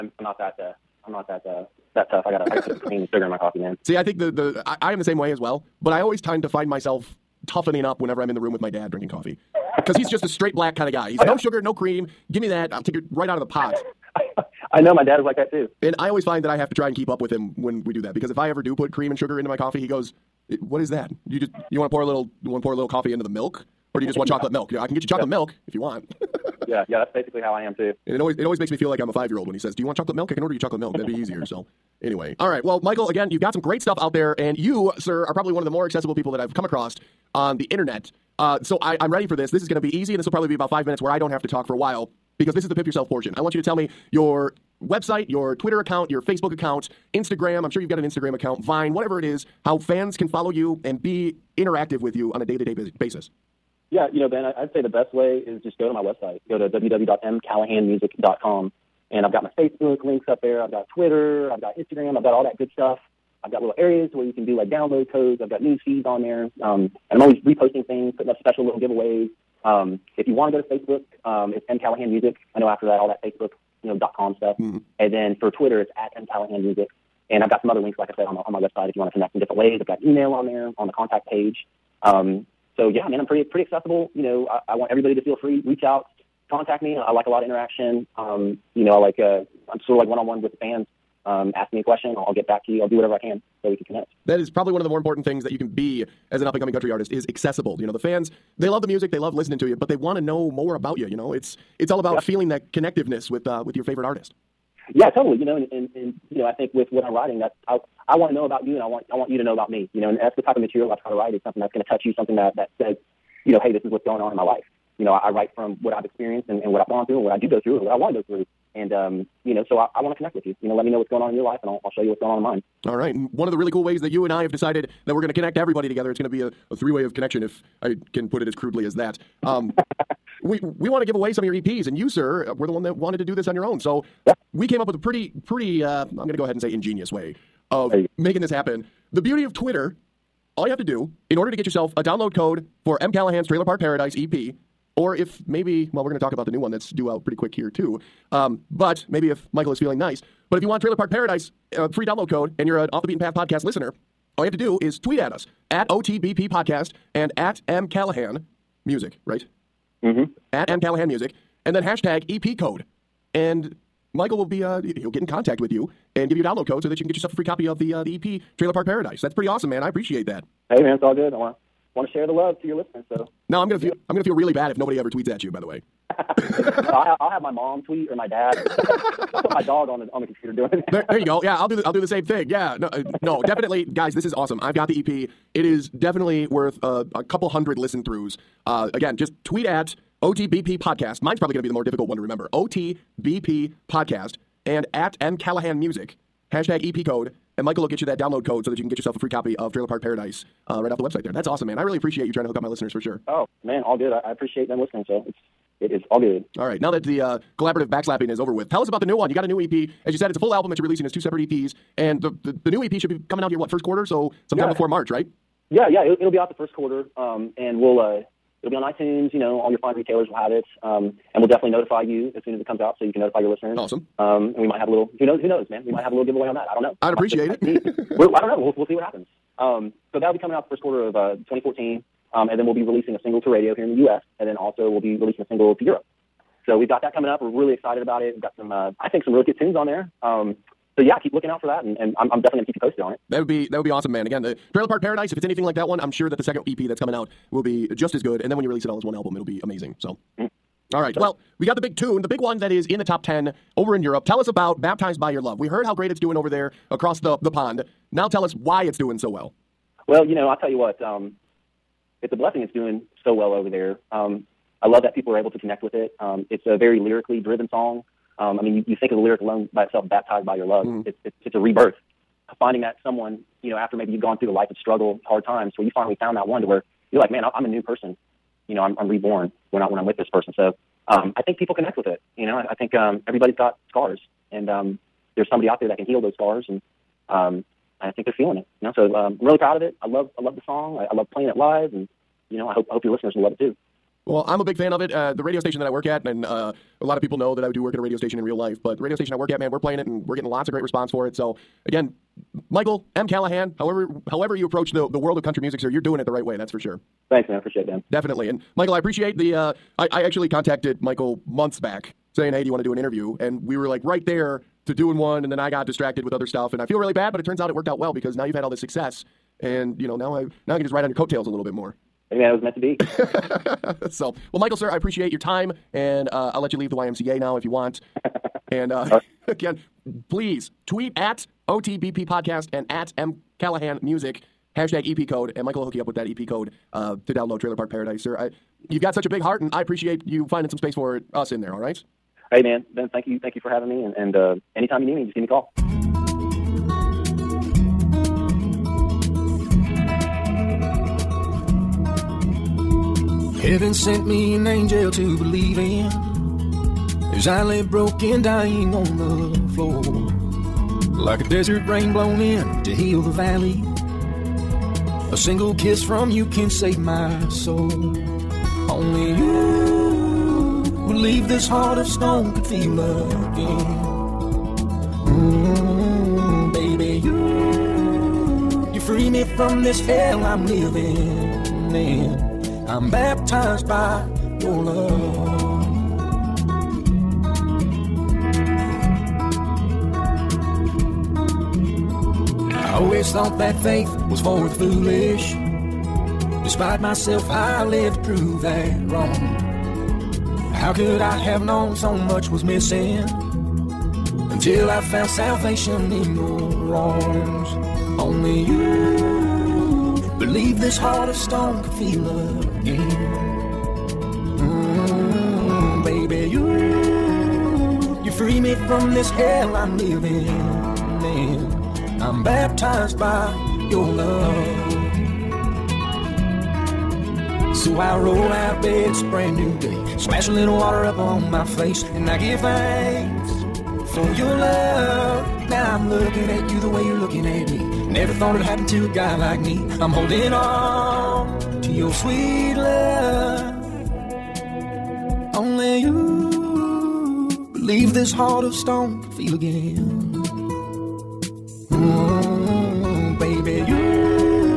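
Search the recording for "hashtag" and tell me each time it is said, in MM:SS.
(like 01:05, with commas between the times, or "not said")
02:41, 03:16, 05:34.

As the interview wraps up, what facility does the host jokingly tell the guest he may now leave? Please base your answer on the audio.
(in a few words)
The YMCA.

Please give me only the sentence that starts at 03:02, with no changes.
Yeah, no, uh, no, definitely, guys.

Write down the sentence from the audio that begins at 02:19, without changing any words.
The beauty of Twitter, all you have to do in order to get yourself a download code for M.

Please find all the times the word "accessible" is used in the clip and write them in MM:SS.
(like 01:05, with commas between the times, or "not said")
00:35, 01:23, 01:37.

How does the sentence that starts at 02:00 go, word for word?
You know, let me know what's going on in your life, and I'll, I'll show you what's going on in mine.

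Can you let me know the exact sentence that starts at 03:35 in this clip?
Yeah, yeah, it, it'll be out the first quarter, um, and we'll uh, it'll be on iTunes.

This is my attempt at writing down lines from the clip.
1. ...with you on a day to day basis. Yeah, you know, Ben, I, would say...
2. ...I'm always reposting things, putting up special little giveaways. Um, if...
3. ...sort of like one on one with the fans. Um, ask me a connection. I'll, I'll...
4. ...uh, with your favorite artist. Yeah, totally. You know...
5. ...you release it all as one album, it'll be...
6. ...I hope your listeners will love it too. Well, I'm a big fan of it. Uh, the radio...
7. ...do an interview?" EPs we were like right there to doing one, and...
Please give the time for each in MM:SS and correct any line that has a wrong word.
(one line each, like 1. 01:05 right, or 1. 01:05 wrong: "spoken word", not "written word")
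1. 00:51 right
2. 01:07 right
3. 01:29 wrong: "question", not "connection"
4. 01:43 right
5. 04:08 right
6. 04:52 right
7. 05:12 wrong: "And", not "EPs".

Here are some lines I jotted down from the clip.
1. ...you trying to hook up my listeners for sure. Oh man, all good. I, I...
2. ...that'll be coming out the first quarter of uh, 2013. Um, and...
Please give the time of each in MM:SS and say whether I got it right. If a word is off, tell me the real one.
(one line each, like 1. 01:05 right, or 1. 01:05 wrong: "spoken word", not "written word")
1. 03:22 right
2. 03:50 wrong: "2014", not "2013".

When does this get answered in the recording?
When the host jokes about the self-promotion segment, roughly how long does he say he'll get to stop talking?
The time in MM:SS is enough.
00:40.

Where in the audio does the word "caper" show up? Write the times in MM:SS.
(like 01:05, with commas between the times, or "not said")
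not said.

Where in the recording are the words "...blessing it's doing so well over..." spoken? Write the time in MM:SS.
04:22.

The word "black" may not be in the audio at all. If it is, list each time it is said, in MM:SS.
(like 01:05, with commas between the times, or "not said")
00:10.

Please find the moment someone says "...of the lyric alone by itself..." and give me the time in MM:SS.
04:29.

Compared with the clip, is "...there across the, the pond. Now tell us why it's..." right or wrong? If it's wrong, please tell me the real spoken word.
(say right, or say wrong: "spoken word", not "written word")
right.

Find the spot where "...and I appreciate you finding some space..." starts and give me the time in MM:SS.
05:39.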